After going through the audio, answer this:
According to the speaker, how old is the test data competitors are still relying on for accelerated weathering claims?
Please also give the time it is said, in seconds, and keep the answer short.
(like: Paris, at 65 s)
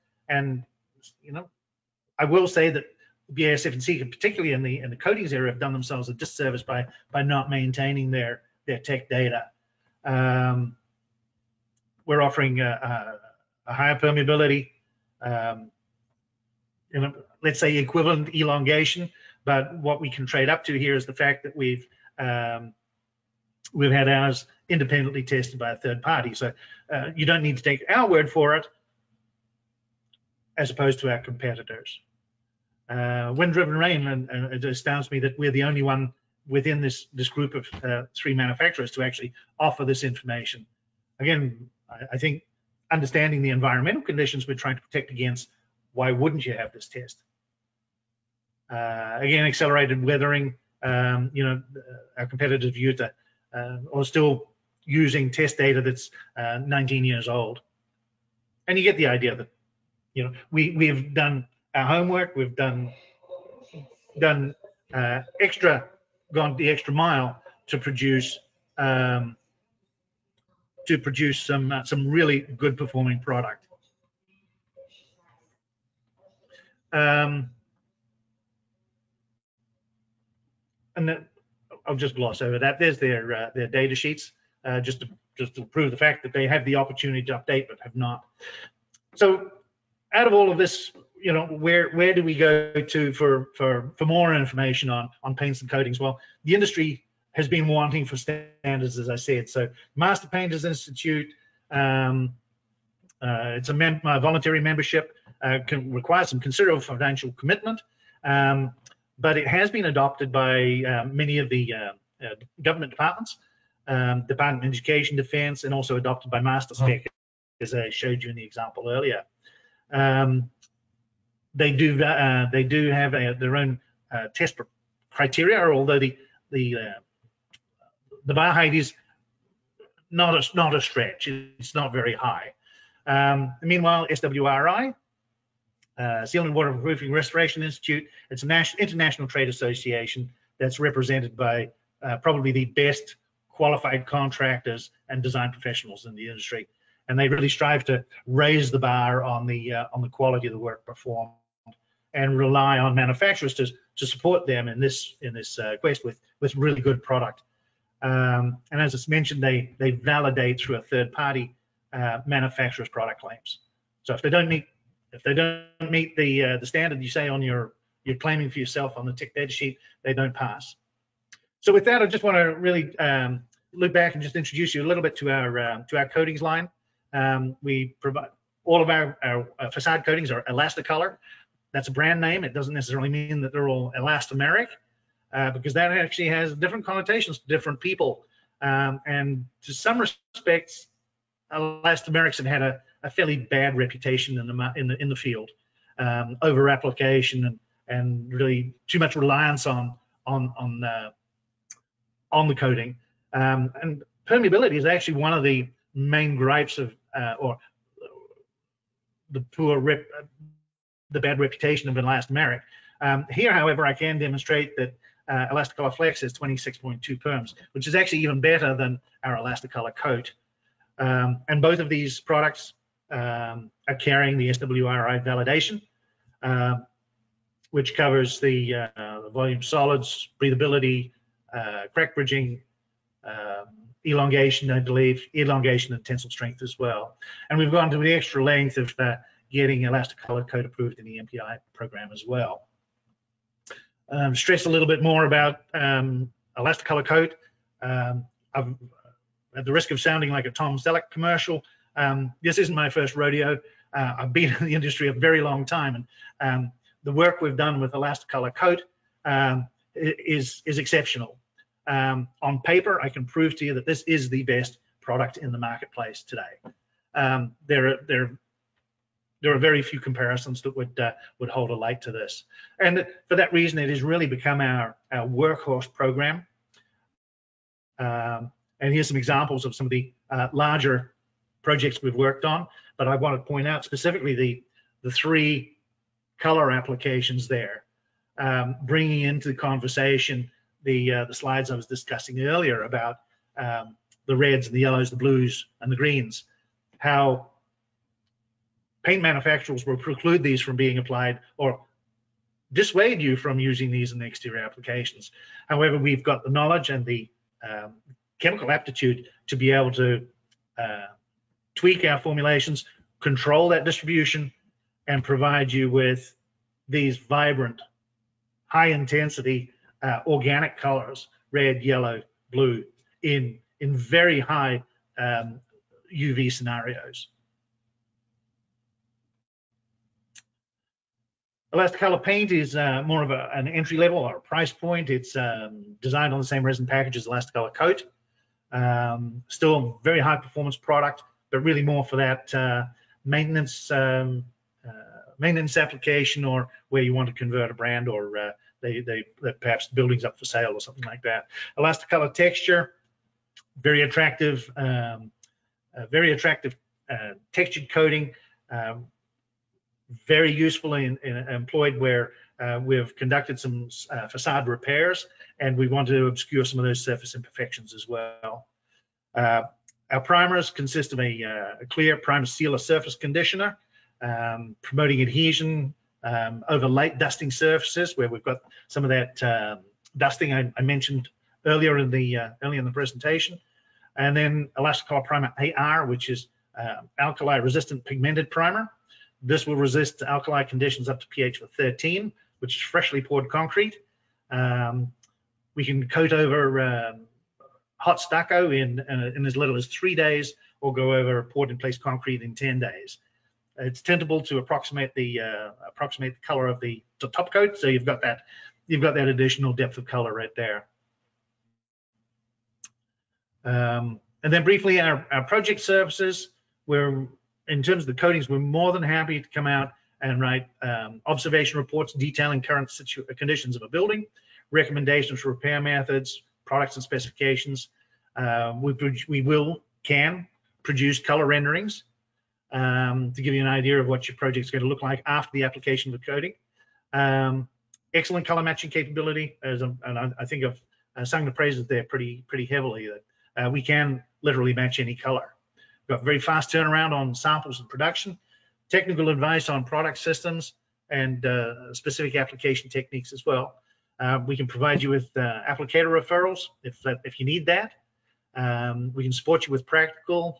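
19 years, at 56 s.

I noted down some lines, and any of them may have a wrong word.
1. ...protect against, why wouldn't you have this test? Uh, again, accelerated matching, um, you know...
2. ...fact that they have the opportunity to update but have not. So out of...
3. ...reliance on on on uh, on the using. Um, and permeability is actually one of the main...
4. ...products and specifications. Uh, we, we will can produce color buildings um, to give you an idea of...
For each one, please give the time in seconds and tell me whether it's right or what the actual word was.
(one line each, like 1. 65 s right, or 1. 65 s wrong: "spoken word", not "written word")
1. 44 s wrong: "weathering", not "matching"
2. 85 s right
3. 199 s wrong: "coating", not "using"
4. 426 s wrong: "renderings", not "buildings".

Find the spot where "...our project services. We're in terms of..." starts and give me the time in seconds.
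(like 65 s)
415 s.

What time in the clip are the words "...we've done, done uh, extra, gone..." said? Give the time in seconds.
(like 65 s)
62 s.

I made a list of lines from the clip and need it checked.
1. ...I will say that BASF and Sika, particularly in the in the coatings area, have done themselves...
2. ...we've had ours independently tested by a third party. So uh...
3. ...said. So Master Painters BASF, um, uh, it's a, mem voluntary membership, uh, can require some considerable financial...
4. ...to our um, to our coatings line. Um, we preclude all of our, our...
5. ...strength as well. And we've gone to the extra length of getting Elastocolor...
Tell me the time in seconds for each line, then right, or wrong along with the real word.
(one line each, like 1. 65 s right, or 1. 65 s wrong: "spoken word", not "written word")
1. 2 s right
2. 23 s right
3. 99 s wrong: "Institute", not "BASF"
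4. 175 s wrong: "provide", not "preclude"
5. 236 s right.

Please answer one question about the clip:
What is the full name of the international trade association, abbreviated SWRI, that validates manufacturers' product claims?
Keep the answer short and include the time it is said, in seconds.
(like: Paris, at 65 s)
Sealant and Waterproofing Restoration Institute, at 136 s.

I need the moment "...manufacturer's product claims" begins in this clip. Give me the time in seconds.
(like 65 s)
162 s.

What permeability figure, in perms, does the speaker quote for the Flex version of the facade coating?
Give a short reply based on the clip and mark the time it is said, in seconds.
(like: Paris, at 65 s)
26.2, at 216 s.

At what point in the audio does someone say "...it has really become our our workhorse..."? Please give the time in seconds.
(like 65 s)
273 s.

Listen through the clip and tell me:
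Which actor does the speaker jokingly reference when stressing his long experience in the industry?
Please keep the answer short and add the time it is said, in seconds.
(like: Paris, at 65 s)
Tom Selleck, at 250 s.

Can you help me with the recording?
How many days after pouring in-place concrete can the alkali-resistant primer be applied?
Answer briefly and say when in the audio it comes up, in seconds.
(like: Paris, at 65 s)
10 days, at 402 s.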